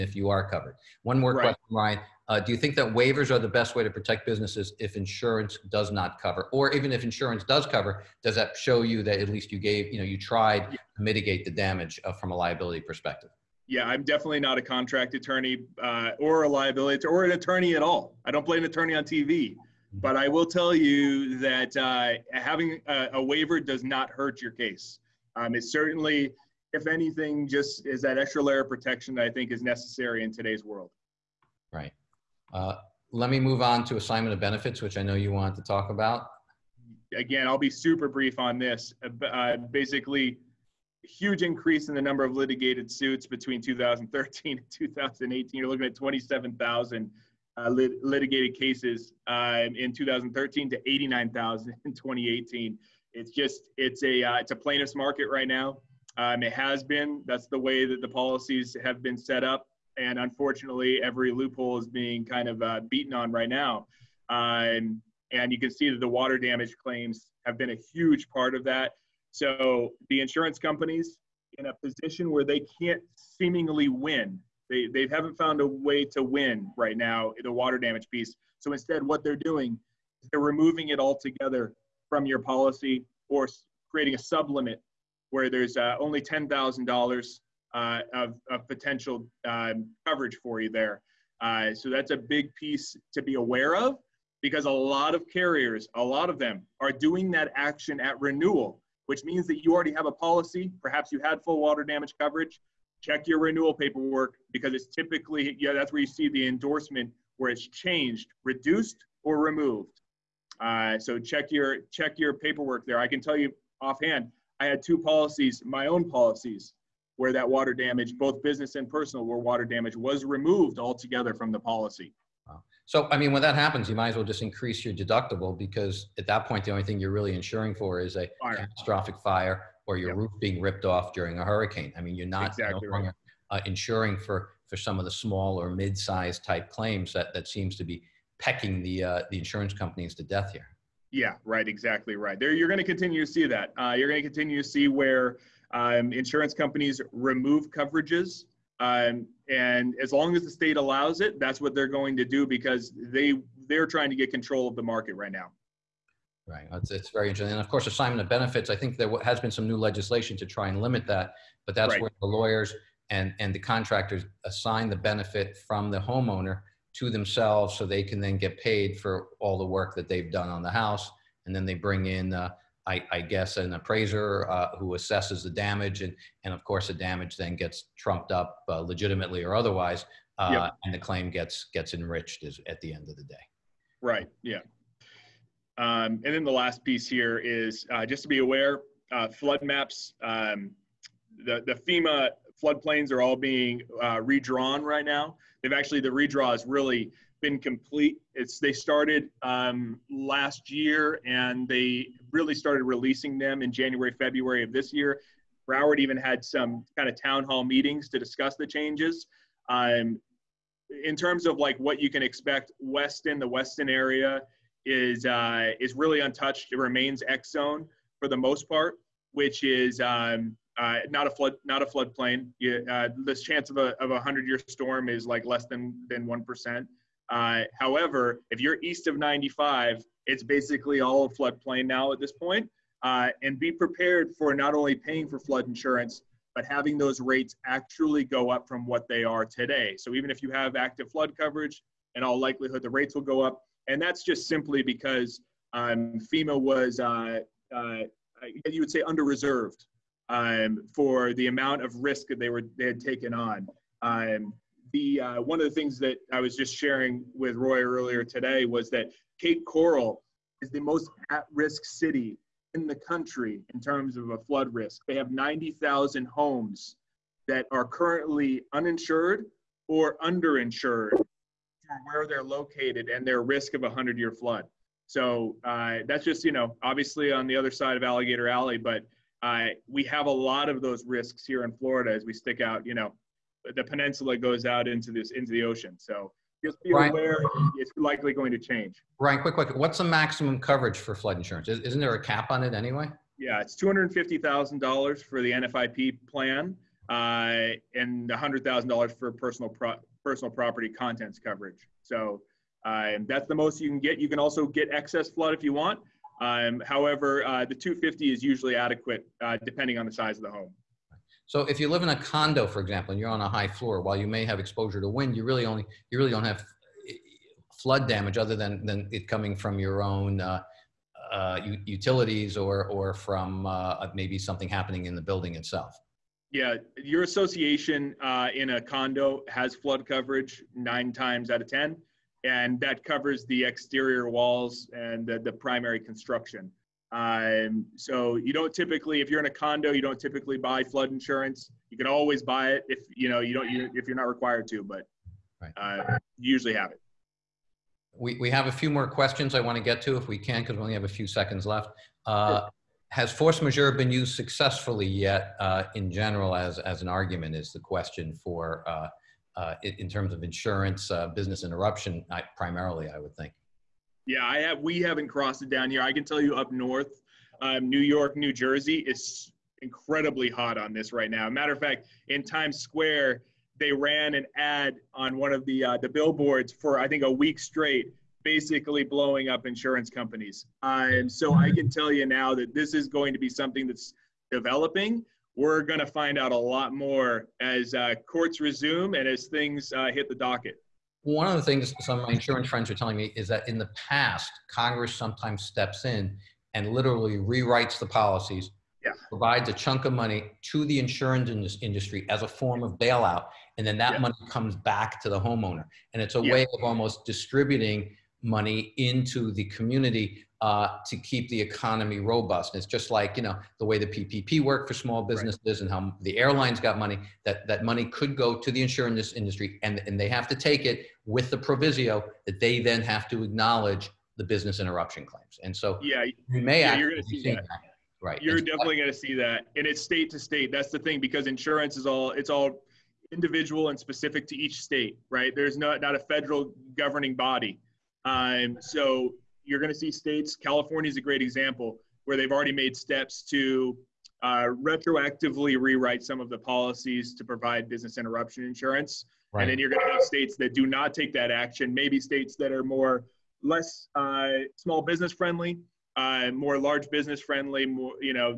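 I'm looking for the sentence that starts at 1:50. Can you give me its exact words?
Uh, so check your check your paperwork there.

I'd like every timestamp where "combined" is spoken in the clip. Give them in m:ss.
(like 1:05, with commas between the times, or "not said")
not said.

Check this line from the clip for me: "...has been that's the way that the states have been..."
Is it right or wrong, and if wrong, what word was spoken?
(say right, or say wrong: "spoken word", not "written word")
wrong: "policies", not "states".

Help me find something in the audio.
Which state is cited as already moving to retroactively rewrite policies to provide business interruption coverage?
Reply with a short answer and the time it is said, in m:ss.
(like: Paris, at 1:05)
California, at 7:20.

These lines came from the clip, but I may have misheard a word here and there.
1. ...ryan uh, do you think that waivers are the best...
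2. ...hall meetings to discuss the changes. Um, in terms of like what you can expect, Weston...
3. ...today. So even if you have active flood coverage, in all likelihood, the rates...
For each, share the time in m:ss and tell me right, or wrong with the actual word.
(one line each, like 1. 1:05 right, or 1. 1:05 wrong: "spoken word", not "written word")
1. 0:01 right
2. 3:27 right
3. 3:59 right.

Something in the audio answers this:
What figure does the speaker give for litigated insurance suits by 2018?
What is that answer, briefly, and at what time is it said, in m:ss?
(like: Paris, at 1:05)
89,000, at 0:50.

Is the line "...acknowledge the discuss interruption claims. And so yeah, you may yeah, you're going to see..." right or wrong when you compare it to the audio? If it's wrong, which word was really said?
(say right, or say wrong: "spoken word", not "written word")
wrong: "business", not "discuss".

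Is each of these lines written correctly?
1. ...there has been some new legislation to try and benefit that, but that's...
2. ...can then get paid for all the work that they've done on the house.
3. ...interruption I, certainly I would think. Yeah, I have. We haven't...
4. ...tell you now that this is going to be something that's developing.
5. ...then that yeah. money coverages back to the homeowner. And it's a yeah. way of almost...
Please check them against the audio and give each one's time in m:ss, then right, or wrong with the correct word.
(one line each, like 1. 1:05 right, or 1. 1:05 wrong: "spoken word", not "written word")
1. 2:38 wrong: "limit", not "benefit"
2. 2:48 right
3. 6:01 wrong: "primarily", not "certainly"
4. 6:21 right
5. 6:43 wrong: "comes", not "coverages".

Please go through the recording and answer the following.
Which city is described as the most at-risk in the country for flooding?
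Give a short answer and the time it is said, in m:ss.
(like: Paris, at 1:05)
Cape Coral, at 4:19.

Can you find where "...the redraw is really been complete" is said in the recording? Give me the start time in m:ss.
3:16.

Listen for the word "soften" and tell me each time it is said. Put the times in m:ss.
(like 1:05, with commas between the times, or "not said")
not said.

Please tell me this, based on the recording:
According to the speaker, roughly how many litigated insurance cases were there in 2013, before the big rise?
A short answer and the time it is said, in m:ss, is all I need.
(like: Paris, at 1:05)
27,000, at 0:45.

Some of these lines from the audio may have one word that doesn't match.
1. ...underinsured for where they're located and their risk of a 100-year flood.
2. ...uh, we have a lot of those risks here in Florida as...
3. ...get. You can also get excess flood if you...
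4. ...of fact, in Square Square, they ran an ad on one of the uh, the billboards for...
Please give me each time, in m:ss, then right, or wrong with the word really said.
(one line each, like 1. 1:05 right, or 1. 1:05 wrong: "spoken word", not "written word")
1. 4:30 right
2. 4:39 right
3. 5:03 right
4. 6:11 wrong: "Times", not "Square".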